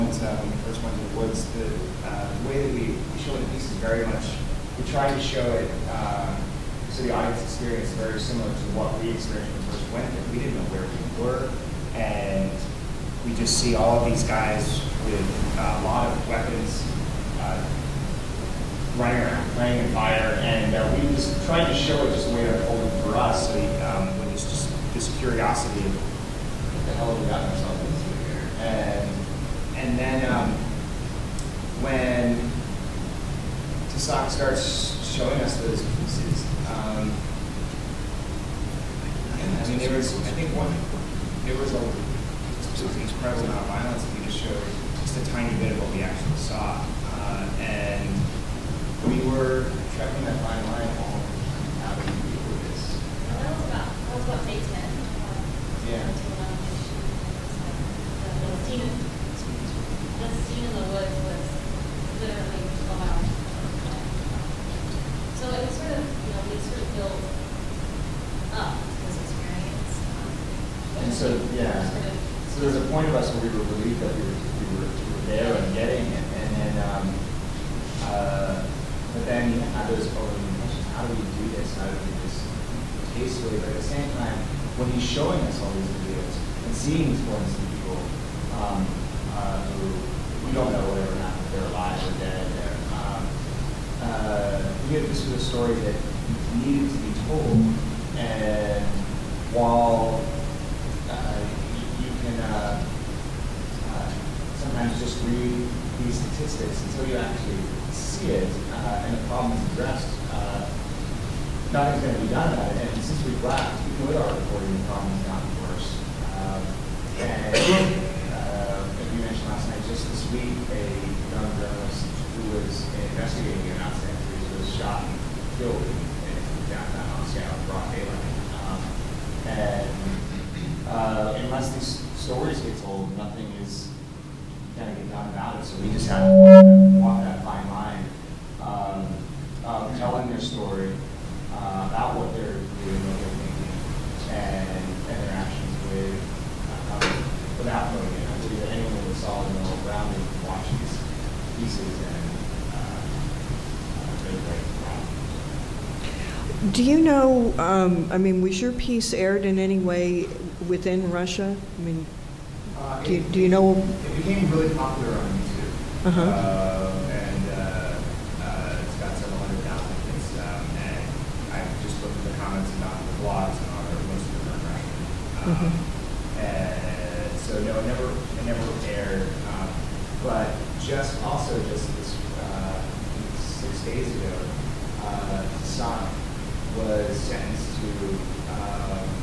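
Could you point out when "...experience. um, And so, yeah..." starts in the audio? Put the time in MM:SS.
01:09.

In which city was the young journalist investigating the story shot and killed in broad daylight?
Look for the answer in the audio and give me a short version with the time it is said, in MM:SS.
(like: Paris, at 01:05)
Moscow, at 02:07.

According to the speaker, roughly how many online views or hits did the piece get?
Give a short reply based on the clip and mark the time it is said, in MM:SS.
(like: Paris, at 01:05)
several hundred thousand, at 02:49.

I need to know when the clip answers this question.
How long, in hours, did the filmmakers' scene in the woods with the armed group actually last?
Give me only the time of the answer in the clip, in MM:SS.
01:02.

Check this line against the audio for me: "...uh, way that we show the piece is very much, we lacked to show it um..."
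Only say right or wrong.
wrong.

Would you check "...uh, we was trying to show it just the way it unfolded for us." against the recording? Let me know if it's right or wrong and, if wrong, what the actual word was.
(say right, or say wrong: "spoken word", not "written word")
right.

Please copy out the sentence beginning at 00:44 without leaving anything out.
We just showed just a tiny bit of what we actually saw.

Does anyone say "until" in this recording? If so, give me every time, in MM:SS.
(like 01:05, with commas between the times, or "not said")
00:56, 01:46.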